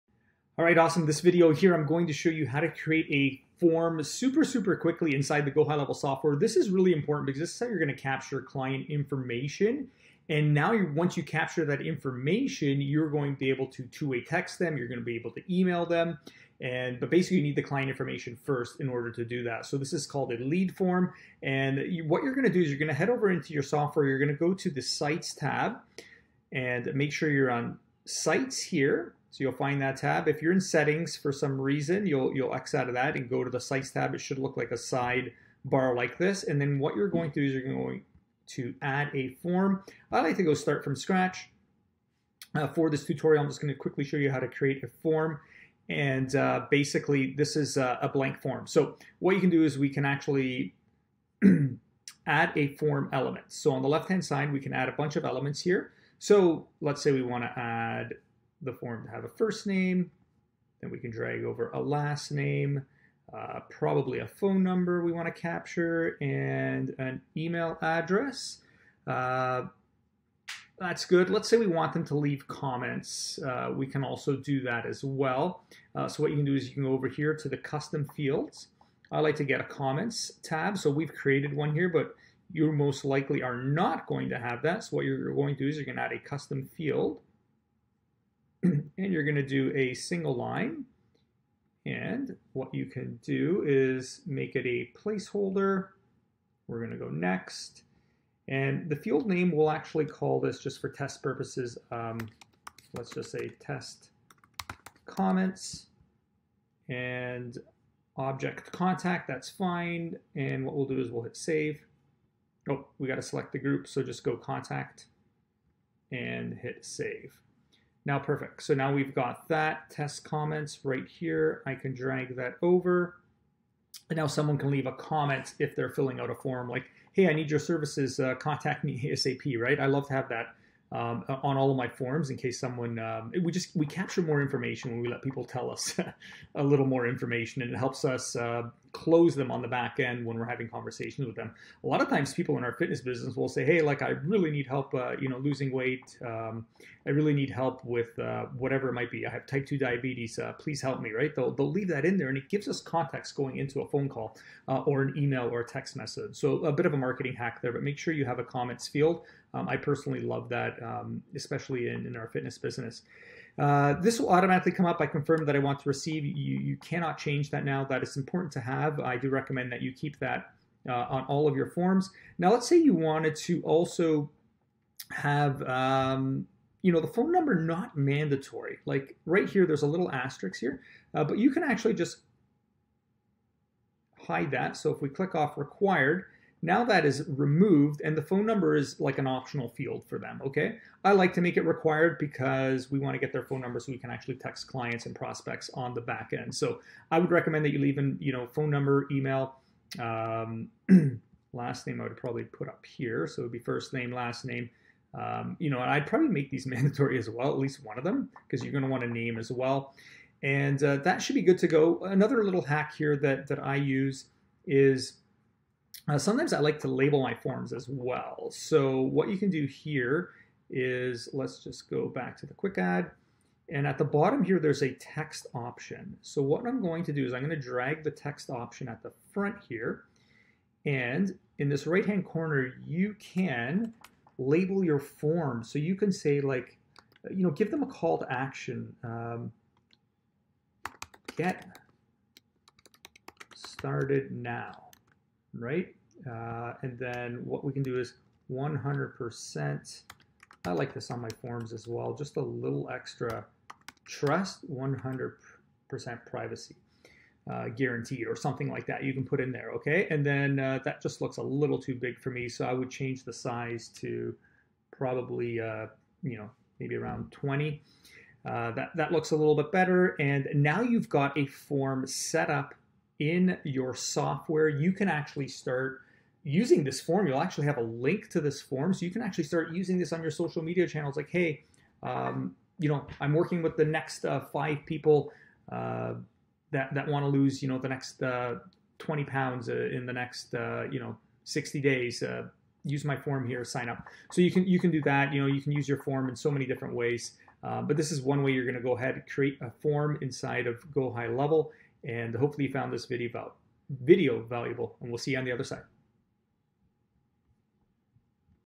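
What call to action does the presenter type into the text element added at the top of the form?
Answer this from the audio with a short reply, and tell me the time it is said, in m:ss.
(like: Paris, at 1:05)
Get started now, at 4:01.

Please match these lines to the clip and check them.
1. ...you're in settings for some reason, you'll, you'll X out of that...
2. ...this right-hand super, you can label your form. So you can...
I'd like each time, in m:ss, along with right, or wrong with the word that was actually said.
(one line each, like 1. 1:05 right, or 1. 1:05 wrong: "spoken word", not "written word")
1. 0:30 right
2. 3:51 wrong: "corner", not "super".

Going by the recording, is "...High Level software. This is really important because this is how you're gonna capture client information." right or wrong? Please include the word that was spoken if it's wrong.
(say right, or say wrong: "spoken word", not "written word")
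right.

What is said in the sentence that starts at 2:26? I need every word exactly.
Um, I really need help with uh, whatever it might be.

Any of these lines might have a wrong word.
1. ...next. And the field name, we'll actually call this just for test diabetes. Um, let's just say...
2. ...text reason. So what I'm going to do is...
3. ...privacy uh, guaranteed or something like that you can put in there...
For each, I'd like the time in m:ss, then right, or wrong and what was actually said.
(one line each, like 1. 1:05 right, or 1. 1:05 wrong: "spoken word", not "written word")
1. 1:37 wrong: "purposes", not "diabetes"
2. 3:44 wrong: "option", not "reason"
3. 4:16 right.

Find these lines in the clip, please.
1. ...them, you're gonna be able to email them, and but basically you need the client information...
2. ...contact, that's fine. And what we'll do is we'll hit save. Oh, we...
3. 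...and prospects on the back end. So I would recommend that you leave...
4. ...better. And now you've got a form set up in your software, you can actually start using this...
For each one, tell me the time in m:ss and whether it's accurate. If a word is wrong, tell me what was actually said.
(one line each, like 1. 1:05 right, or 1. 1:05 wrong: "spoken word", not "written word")
1. 0:14 right
2. 1:48 right
3. 3:15 right
4. 4:29 right.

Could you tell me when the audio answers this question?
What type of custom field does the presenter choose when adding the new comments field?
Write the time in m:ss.
1:29.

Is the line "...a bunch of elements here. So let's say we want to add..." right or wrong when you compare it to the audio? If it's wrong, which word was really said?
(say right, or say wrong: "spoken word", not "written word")
right.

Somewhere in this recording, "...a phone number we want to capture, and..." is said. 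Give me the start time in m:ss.
1:04.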